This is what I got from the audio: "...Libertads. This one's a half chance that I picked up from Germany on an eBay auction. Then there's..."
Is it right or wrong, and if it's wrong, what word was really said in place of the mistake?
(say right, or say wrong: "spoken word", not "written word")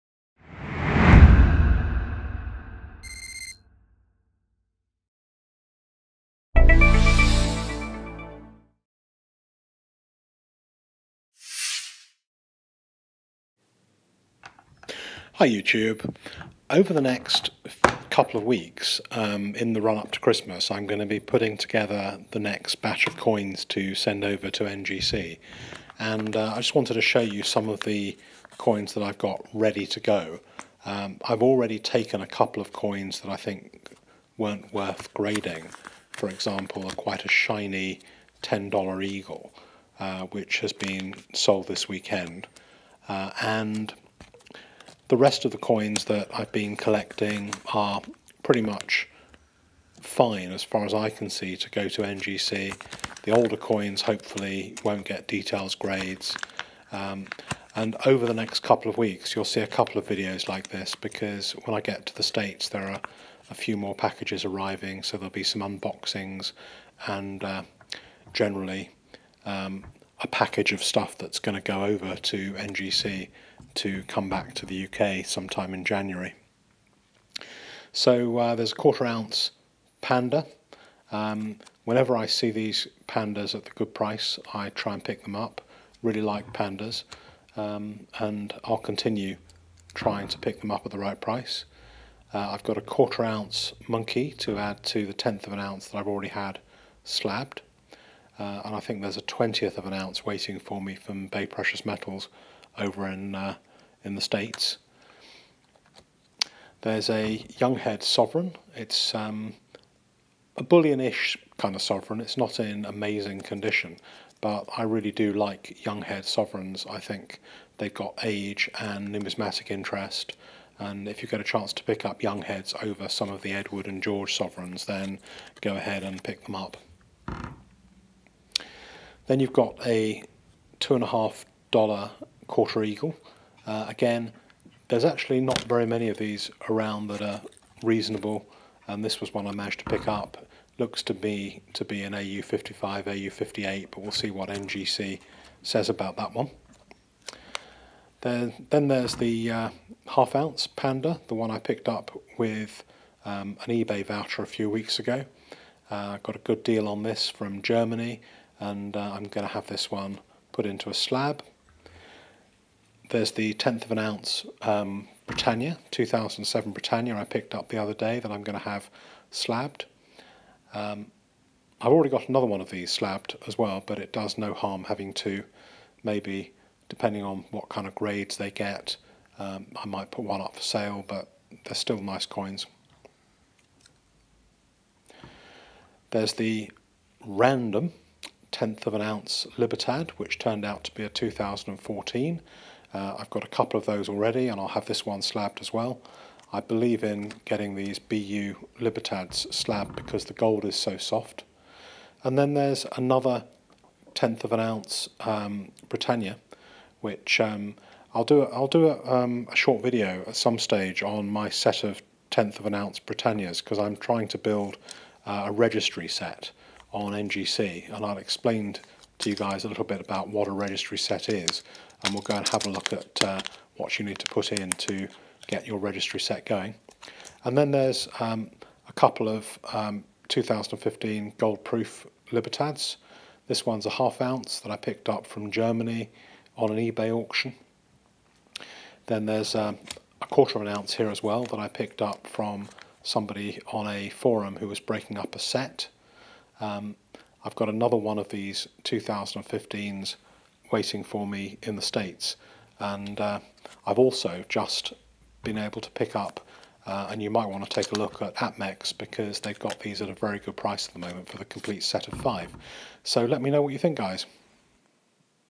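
wrong: "ounce", not "chance".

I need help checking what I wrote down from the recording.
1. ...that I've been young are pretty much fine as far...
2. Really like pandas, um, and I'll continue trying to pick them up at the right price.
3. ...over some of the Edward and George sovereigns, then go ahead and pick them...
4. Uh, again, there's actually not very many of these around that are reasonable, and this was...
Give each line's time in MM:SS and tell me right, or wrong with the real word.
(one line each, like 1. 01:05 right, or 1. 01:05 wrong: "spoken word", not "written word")
1. 00:46 wrong: "collecting", not "young"
2. 01:26 right
3. 02:02 right
4. 02:13 right.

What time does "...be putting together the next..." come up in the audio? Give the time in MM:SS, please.
00:21.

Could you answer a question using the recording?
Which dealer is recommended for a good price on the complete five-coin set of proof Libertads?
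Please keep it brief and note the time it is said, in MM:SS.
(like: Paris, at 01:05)
APMEX, at 04:18.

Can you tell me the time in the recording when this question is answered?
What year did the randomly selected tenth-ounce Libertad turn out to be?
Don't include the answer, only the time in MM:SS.
03:11.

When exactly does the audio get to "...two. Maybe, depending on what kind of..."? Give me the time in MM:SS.
02:55.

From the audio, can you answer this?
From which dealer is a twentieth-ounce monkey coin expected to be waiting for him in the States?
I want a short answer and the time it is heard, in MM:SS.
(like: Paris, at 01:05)
Bay Precious Metals, at 01:41.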